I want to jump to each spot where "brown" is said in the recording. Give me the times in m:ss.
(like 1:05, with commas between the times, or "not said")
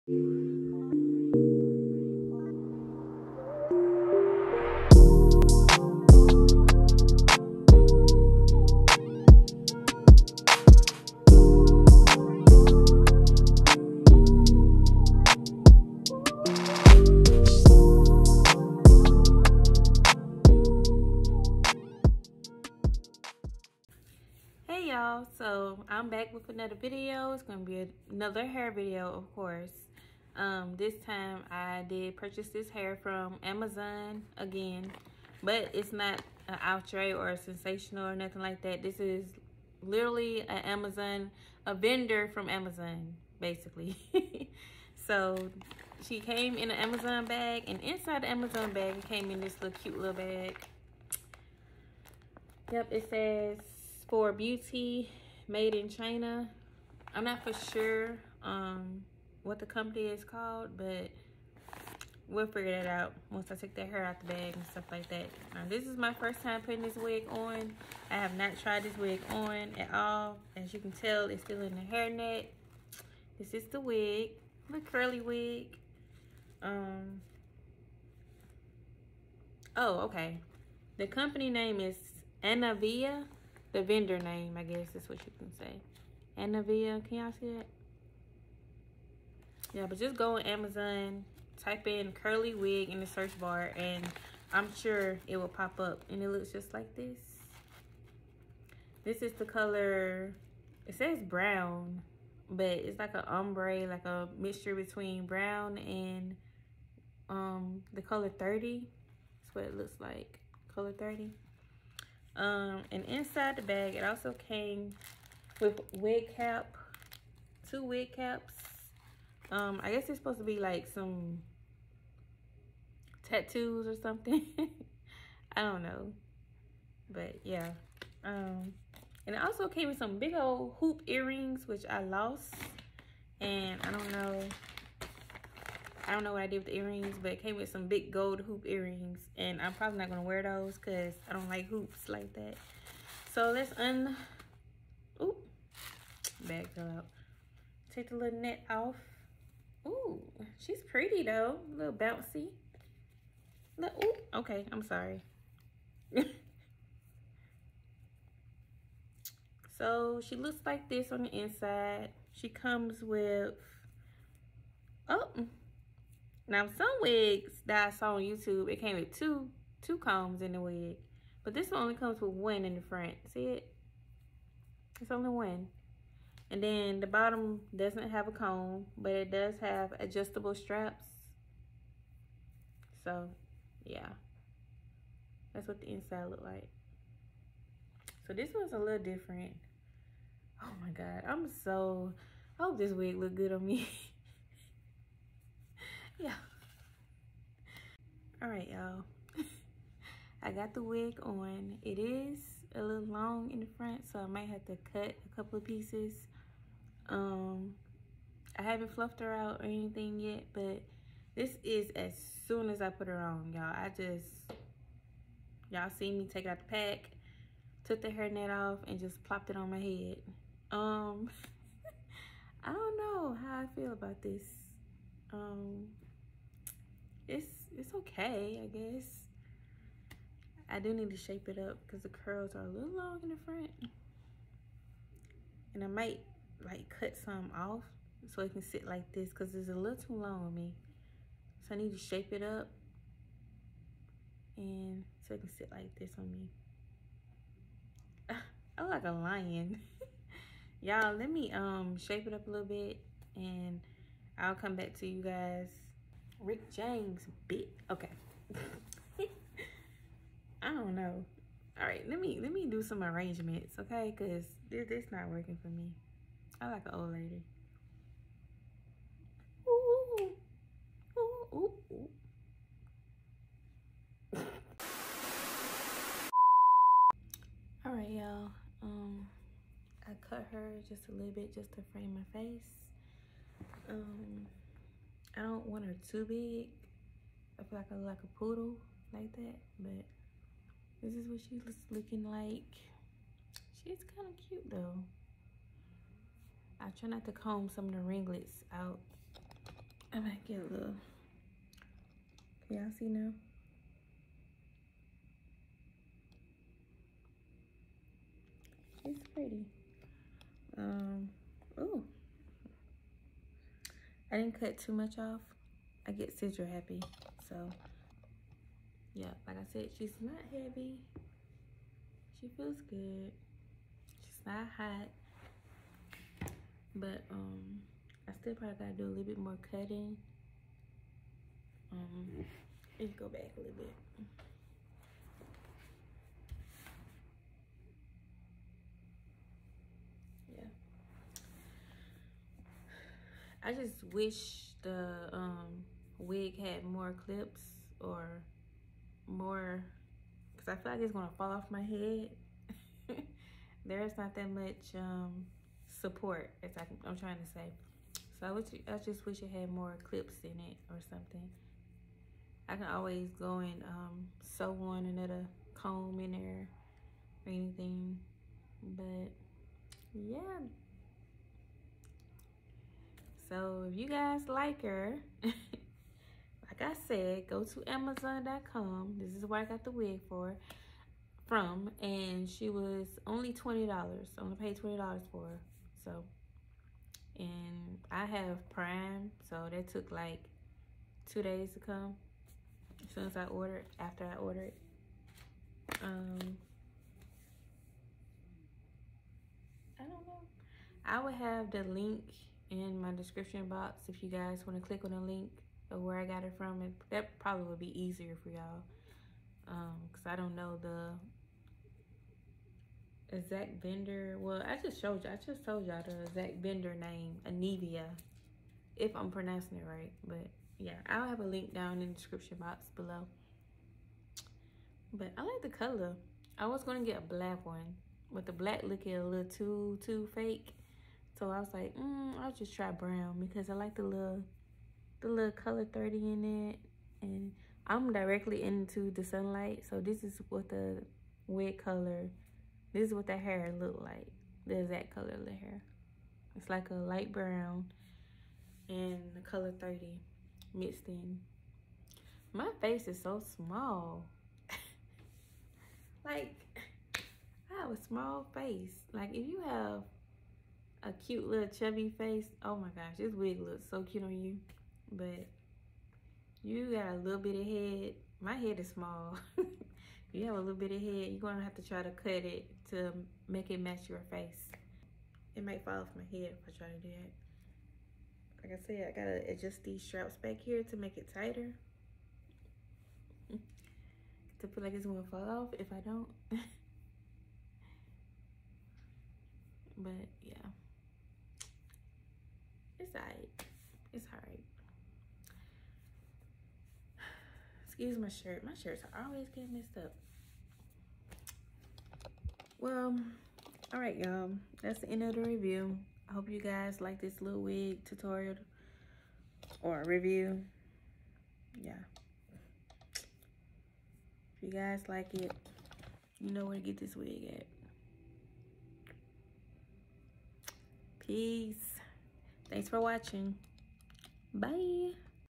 1:41, 1:45, 7:12, 7:27.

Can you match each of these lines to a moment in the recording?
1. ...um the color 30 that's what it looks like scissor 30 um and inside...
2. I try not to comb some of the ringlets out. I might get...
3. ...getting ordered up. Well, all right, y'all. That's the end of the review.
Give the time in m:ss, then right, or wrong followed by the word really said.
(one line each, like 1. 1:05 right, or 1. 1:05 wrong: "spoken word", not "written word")
1. 1:47 wrong: "color", not "scissor"
2. 4:56 right
3. 8:19 wrong: "messed", not "ordered".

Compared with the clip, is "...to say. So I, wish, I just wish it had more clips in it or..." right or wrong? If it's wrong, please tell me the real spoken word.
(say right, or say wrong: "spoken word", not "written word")
right.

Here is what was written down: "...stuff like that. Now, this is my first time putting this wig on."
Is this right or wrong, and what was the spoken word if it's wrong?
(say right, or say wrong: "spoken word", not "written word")
right.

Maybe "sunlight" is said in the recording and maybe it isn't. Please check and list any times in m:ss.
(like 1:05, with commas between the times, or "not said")
7:19.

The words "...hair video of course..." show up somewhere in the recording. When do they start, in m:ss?
0:28.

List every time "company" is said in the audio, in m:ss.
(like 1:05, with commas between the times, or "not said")
0:59, 1:21.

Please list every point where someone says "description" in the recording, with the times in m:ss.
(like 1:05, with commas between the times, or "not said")
6:43, 7:02.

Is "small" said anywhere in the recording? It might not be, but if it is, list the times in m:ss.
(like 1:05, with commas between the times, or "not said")
7:33, 7:38, 7:48.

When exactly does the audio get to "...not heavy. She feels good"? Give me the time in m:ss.
5:20.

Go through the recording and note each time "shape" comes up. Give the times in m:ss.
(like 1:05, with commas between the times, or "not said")
3:51, 4:01, 4:11.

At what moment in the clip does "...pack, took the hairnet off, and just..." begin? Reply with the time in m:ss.
3:36.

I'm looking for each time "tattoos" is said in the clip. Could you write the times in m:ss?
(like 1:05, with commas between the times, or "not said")
2:03.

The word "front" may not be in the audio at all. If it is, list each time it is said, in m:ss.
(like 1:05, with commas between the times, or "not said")
2:52, 3:23, 3:53.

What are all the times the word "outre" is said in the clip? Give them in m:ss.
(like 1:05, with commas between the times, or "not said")
0:36.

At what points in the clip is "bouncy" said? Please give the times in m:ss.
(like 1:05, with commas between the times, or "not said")
2:31.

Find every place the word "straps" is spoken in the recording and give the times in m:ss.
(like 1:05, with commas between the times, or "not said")
3:00, 8:00.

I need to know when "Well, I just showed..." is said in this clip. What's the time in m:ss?
6:54.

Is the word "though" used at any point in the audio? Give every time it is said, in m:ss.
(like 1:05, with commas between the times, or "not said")
2:31, 4:54.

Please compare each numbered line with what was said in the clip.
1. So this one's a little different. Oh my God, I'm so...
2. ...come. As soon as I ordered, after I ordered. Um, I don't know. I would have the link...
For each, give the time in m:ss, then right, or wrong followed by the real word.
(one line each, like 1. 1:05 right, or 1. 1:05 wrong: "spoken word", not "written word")
1. 3:08 right
2. 6:31 right.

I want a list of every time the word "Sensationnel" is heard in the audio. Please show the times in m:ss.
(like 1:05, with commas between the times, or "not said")
0:37.